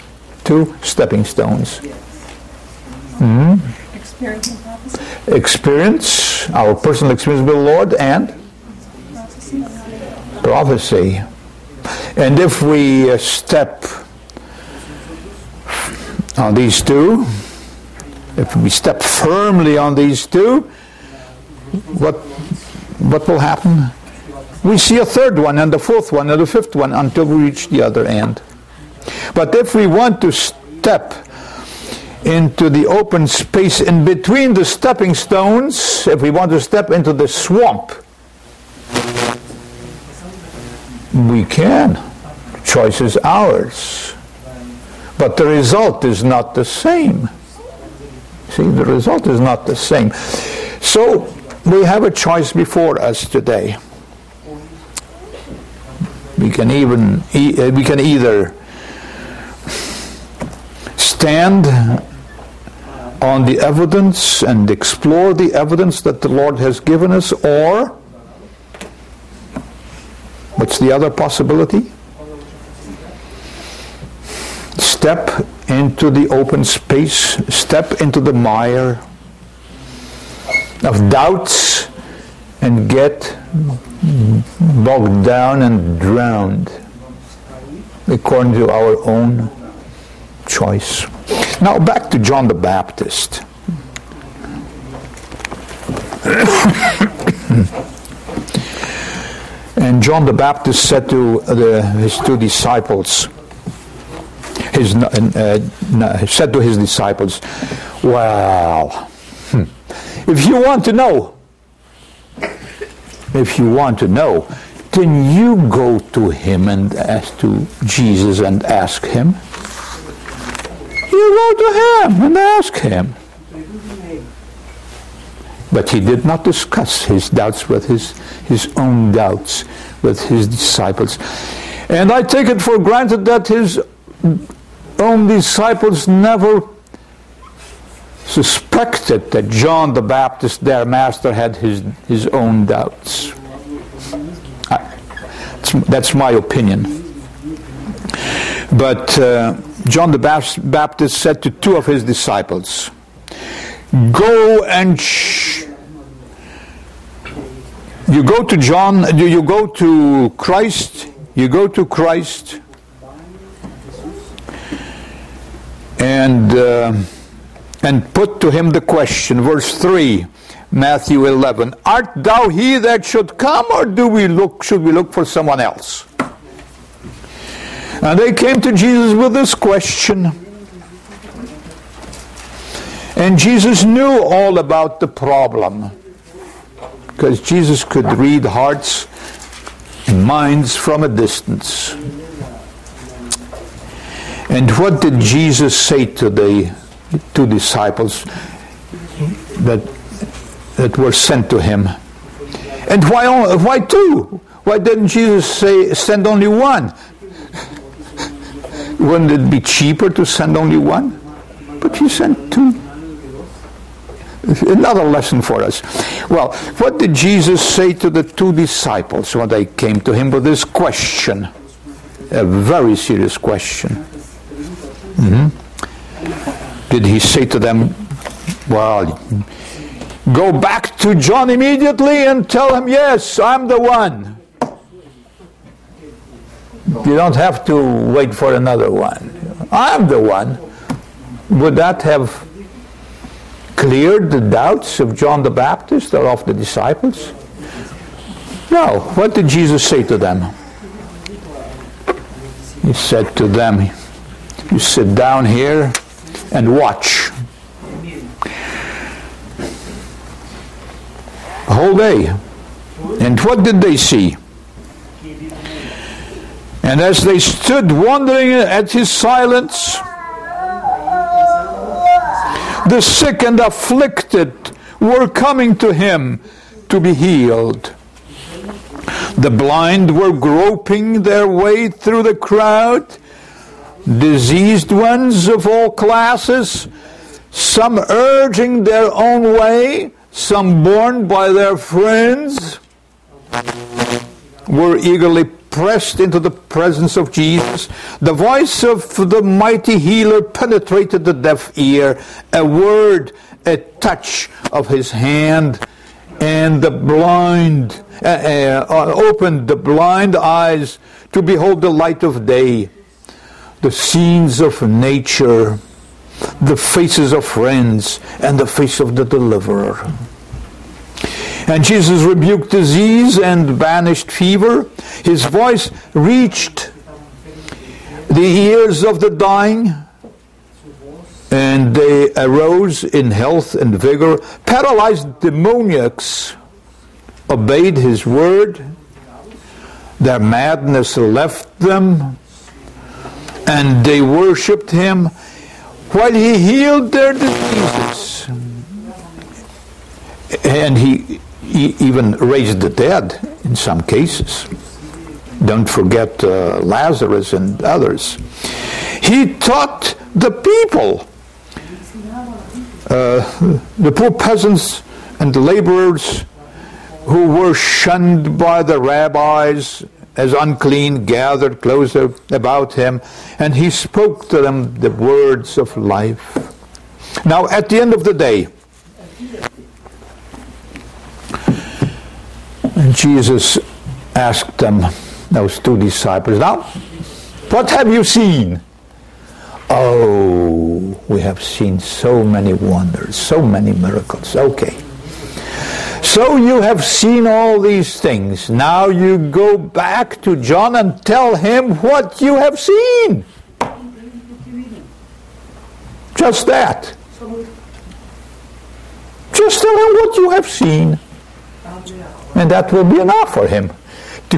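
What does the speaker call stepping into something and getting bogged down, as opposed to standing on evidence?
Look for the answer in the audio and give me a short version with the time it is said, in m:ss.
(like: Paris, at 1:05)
The mire of doubts, at 1:18.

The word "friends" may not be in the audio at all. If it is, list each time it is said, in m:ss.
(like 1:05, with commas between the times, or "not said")
4:51, 5:17.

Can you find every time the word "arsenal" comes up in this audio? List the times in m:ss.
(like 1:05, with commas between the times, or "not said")
not said.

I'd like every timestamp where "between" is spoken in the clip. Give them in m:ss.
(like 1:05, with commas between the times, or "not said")
0:34.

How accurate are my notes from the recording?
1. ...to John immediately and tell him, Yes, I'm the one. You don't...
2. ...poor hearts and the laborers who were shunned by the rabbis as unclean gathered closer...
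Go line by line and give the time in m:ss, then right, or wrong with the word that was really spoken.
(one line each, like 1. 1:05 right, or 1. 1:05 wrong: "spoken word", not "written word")
1. 3:50 right
2. 6:04 wrong: "peasants", not "hearts".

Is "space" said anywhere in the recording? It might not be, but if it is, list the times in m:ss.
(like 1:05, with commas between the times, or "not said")
0:33, 1:16.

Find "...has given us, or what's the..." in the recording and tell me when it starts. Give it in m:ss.
1:06.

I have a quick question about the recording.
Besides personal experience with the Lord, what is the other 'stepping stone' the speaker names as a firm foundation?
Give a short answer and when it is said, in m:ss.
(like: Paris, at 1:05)
Prophecy, at 0:10.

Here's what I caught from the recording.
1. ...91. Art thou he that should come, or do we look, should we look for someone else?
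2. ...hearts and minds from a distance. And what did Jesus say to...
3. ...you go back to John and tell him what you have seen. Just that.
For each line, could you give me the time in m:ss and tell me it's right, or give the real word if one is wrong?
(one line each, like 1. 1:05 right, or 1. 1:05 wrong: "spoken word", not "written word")
1. 2:51 wrong: "11", not "91"
2. 3:08 right
3. 6:39 right.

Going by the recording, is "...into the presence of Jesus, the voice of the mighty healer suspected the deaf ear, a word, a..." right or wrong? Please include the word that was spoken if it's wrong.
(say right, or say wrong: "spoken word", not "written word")
wrong: "penetrated", not "suspected".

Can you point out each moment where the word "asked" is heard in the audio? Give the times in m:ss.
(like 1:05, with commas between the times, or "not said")
2:02, 6:24.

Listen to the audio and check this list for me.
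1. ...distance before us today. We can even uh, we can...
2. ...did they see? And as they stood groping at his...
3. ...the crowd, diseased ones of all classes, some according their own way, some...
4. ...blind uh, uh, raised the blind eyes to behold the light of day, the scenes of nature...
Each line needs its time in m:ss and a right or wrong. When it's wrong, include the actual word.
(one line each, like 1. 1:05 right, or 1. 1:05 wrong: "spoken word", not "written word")
1. 0:52 wrong: "choice", not "distance"
2. 4:23 wrong: "wondering", not "groping"
3. 4:42 wrong: "urging", not "according"
4. 5:06 wrong: "opened", not "raised".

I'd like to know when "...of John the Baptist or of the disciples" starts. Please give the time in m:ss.
4:05.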